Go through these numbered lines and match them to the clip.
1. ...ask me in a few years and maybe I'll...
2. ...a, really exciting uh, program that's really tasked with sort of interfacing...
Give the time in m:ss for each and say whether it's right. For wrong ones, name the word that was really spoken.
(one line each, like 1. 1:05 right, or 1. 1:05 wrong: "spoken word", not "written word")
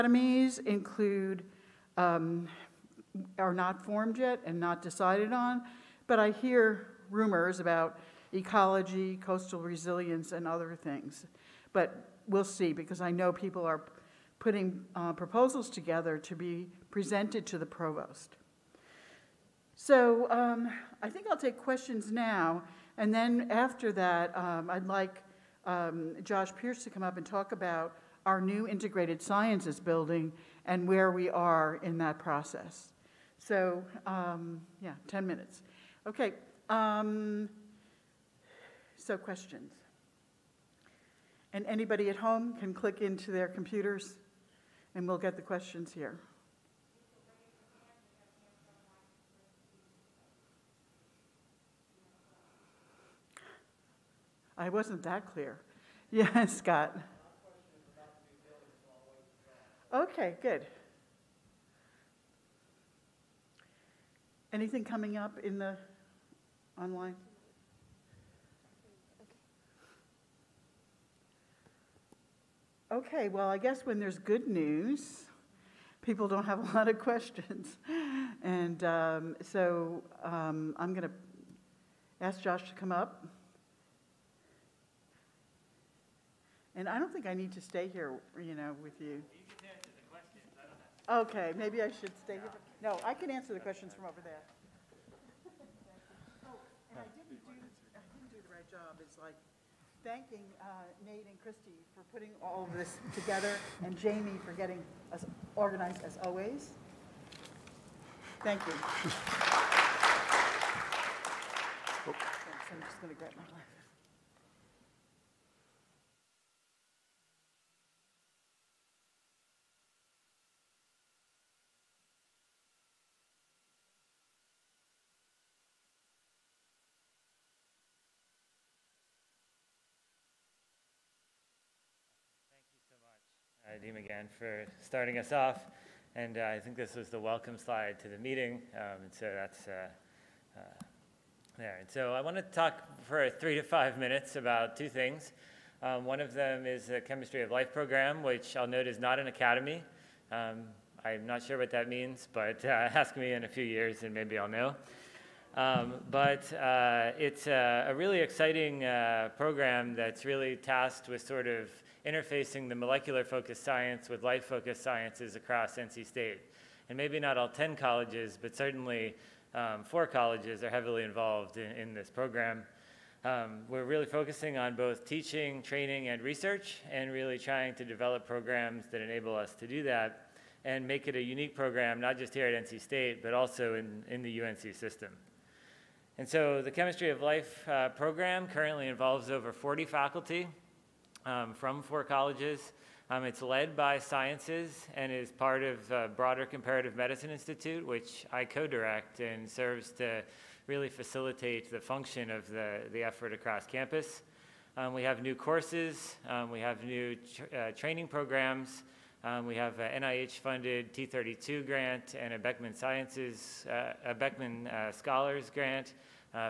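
1. 2:32 right
2. 2:37 right.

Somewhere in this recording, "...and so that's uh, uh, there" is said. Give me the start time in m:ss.
2:19.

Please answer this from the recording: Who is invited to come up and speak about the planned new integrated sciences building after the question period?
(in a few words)
Josh Pierce.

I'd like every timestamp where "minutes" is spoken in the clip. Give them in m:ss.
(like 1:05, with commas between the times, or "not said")
0:35, 2:23.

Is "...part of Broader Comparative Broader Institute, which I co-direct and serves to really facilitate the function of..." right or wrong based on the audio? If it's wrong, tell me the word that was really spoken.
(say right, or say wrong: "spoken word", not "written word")
wrong: "Medicine", not "Broader".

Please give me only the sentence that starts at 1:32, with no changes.
No, I can answer the questions from over there.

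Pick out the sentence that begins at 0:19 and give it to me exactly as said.
So um, I think I'll take questions now.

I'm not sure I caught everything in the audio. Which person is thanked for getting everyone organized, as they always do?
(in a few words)
Jamie.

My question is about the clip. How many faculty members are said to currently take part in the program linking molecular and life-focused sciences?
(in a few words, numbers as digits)
over 40.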